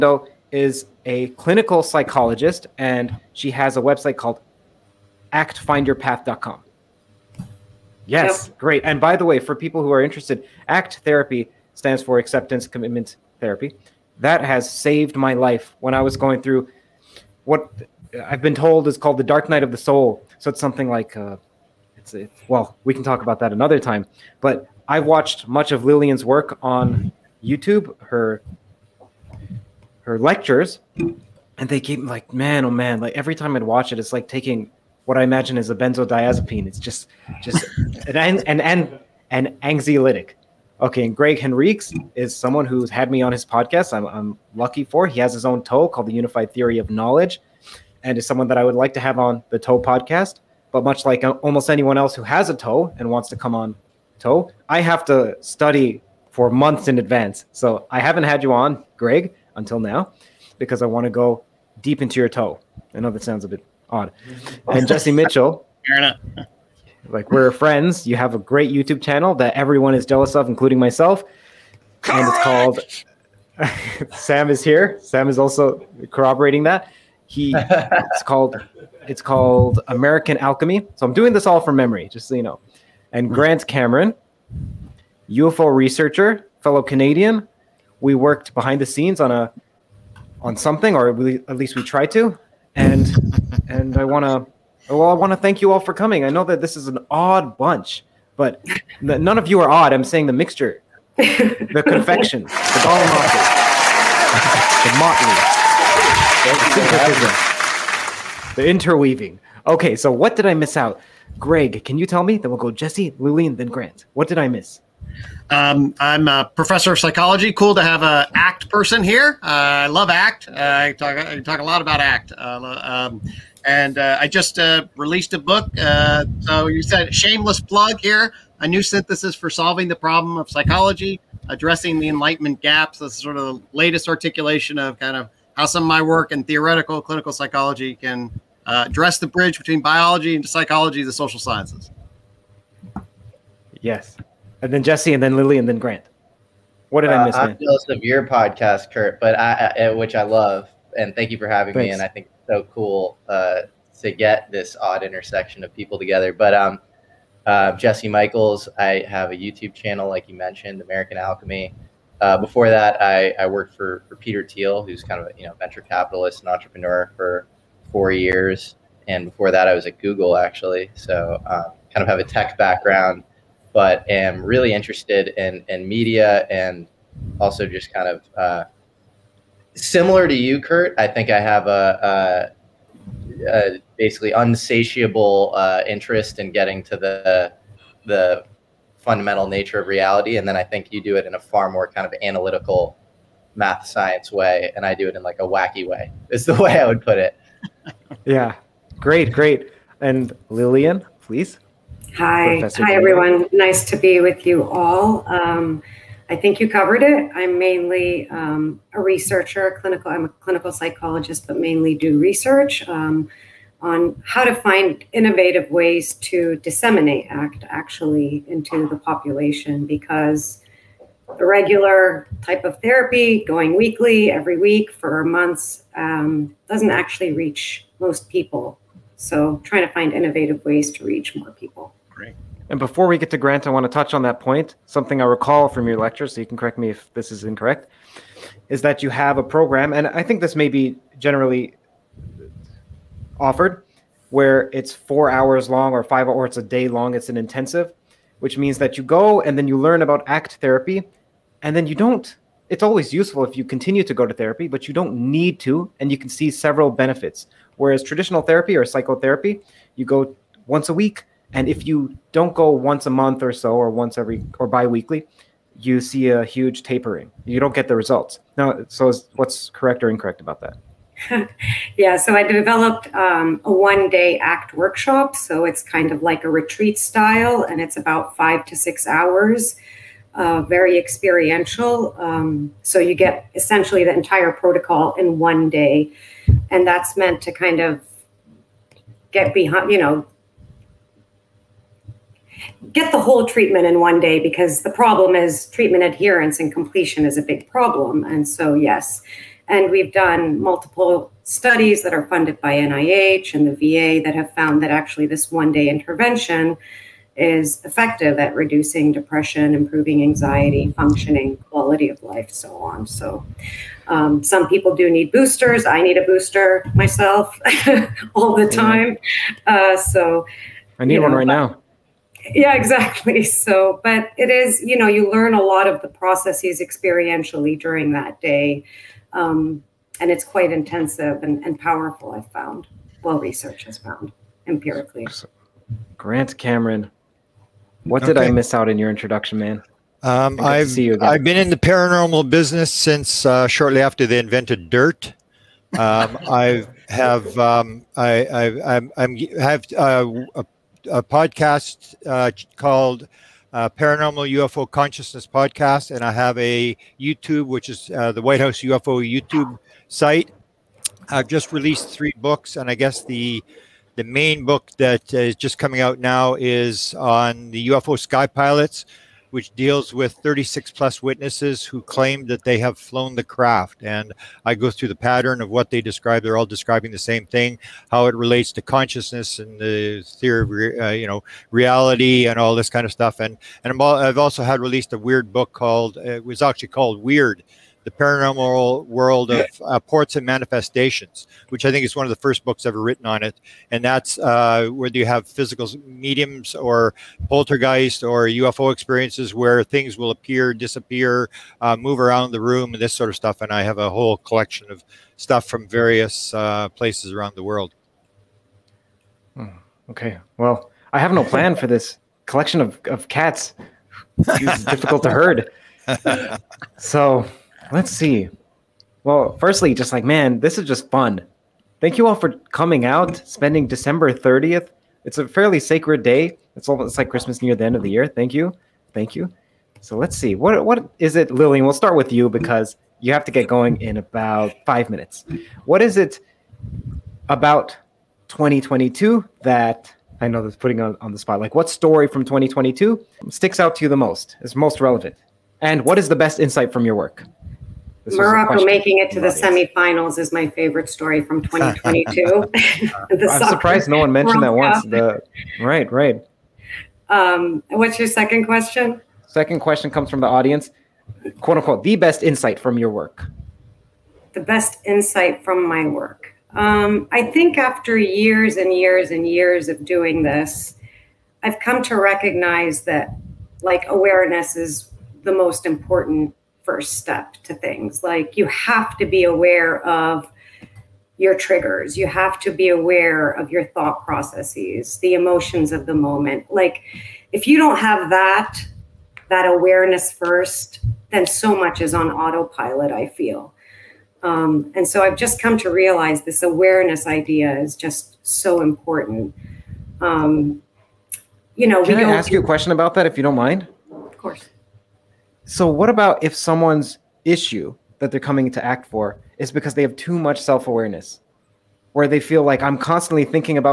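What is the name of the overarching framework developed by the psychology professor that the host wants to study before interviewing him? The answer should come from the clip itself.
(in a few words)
Unified Theory of Knowledge.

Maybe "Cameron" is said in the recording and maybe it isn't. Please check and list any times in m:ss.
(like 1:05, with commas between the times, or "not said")
1:23, 5:36.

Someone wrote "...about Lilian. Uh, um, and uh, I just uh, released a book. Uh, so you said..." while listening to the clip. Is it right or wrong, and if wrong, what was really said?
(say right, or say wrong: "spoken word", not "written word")
wrong: "ACT", not "Lilian".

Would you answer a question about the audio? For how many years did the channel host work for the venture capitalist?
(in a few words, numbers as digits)
4.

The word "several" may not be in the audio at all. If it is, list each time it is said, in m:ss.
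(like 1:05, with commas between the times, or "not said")
4:16.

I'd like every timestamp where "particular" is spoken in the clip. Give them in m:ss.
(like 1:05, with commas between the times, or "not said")
not said.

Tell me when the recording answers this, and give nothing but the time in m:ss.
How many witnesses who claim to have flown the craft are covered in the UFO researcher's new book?
6:10.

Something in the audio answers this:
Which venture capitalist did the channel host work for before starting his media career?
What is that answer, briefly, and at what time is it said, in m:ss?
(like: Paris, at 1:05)
Peter Thiel, at 2:44.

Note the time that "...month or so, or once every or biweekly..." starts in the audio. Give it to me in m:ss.
4:23.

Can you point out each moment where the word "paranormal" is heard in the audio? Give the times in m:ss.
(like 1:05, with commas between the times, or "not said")
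5:41, 5:53, 6:28.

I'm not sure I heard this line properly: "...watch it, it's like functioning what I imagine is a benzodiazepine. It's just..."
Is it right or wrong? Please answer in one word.
wrong.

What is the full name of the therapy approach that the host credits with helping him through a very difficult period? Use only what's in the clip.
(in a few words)
Acceptance commitment therapy.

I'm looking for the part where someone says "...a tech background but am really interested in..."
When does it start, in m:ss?
2:52.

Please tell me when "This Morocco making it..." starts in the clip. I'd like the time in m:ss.
7:28.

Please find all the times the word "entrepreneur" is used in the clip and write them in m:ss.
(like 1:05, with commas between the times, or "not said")
2:46.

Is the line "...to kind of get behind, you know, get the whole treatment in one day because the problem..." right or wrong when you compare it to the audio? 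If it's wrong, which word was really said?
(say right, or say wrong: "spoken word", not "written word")
right.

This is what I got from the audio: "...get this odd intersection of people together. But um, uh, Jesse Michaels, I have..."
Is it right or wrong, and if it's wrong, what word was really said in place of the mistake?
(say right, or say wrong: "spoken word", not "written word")
right.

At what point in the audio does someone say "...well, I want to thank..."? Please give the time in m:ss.
1:34.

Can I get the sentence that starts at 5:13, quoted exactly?
So, um, some people do need boosters.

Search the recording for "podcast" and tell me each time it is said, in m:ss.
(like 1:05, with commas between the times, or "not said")
0:43, 0:49, 2:28, 5:51, 5:55.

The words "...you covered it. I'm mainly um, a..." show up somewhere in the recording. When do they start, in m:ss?
3:26.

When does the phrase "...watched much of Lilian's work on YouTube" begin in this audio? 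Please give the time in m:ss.
0:25.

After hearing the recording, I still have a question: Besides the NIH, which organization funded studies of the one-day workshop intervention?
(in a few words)
The VA.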